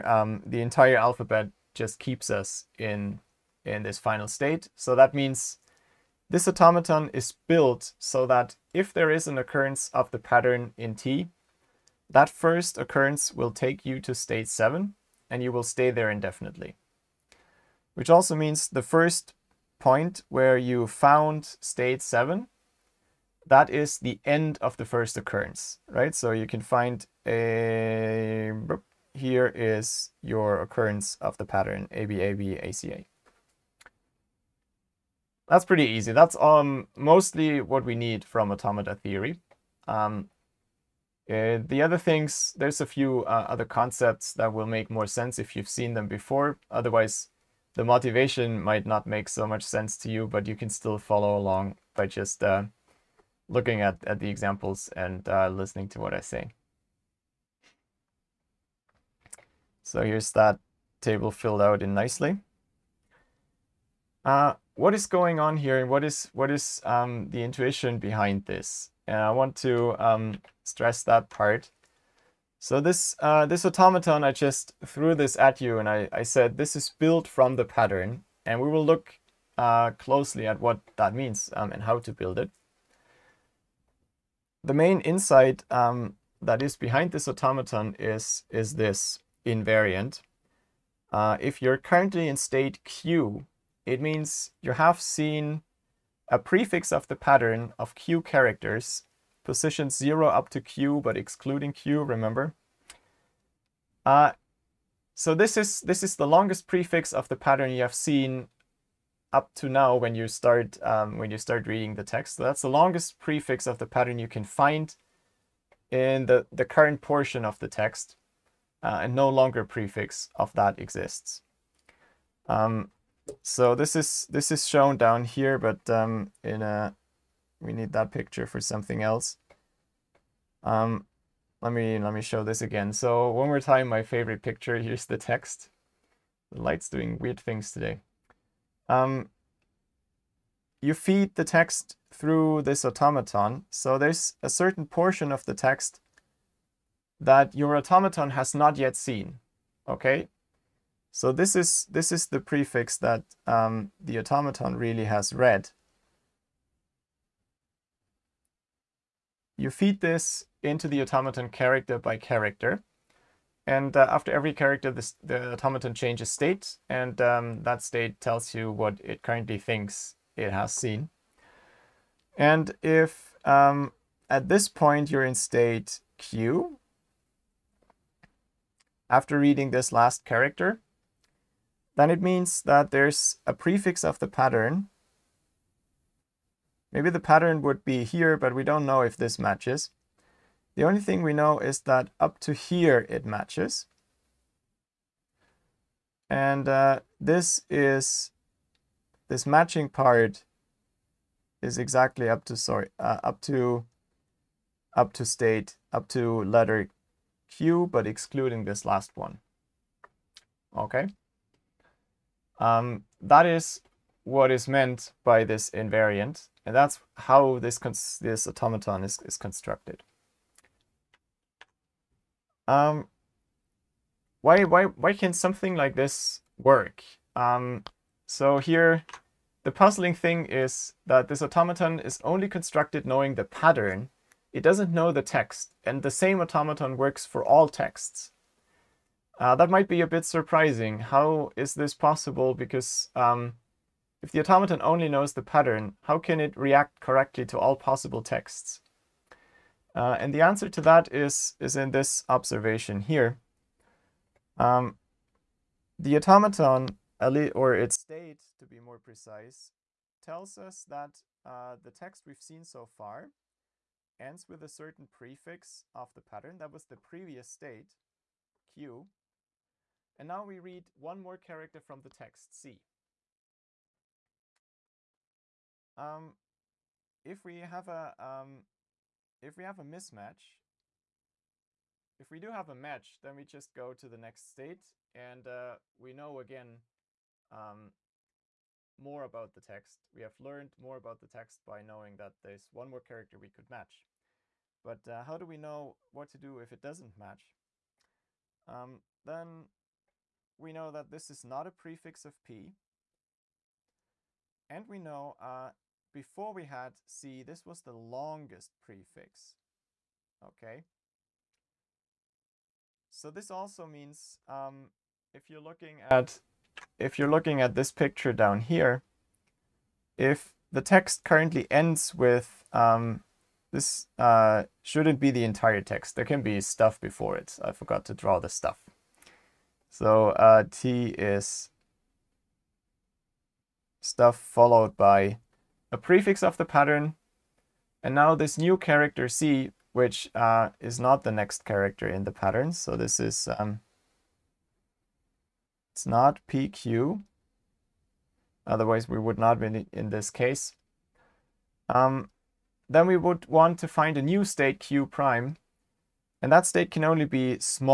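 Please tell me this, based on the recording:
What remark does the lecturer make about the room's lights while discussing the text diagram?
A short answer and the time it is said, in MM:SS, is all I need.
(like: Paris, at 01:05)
doing weird things, at 02:16.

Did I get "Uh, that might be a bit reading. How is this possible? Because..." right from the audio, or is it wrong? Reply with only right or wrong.
wrong.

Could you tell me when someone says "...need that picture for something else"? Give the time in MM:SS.
02:07.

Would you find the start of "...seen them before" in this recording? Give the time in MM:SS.
00:45.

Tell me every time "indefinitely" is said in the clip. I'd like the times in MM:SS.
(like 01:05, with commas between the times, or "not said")
00:16.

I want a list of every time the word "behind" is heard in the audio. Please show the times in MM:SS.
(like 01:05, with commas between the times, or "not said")
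01:07, 01:26.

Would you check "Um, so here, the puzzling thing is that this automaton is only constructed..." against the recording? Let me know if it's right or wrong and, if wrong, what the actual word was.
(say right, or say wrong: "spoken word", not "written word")
right.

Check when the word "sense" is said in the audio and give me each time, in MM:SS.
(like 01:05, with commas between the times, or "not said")
00:45, 00:49.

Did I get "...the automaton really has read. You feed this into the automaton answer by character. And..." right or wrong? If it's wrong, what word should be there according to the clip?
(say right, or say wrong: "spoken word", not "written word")
wrong: "character", not "answer".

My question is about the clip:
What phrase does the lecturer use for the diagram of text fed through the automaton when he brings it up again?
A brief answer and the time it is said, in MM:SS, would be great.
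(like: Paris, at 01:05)
my favorite picture, at 02:13.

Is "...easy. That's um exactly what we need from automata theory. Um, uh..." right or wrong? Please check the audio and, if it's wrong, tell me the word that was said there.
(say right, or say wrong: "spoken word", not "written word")
wrong: "mostly", not "exactly".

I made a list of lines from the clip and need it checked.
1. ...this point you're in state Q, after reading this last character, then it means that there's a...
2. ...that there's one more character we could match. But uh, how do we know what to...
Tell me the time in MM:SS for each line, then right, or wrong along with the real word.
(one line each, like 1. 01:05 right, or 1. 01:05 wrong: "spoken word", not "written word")
1. 02:54 right
2. 04:52 right.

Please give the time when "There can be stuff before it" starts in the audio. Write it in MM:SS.
05:26.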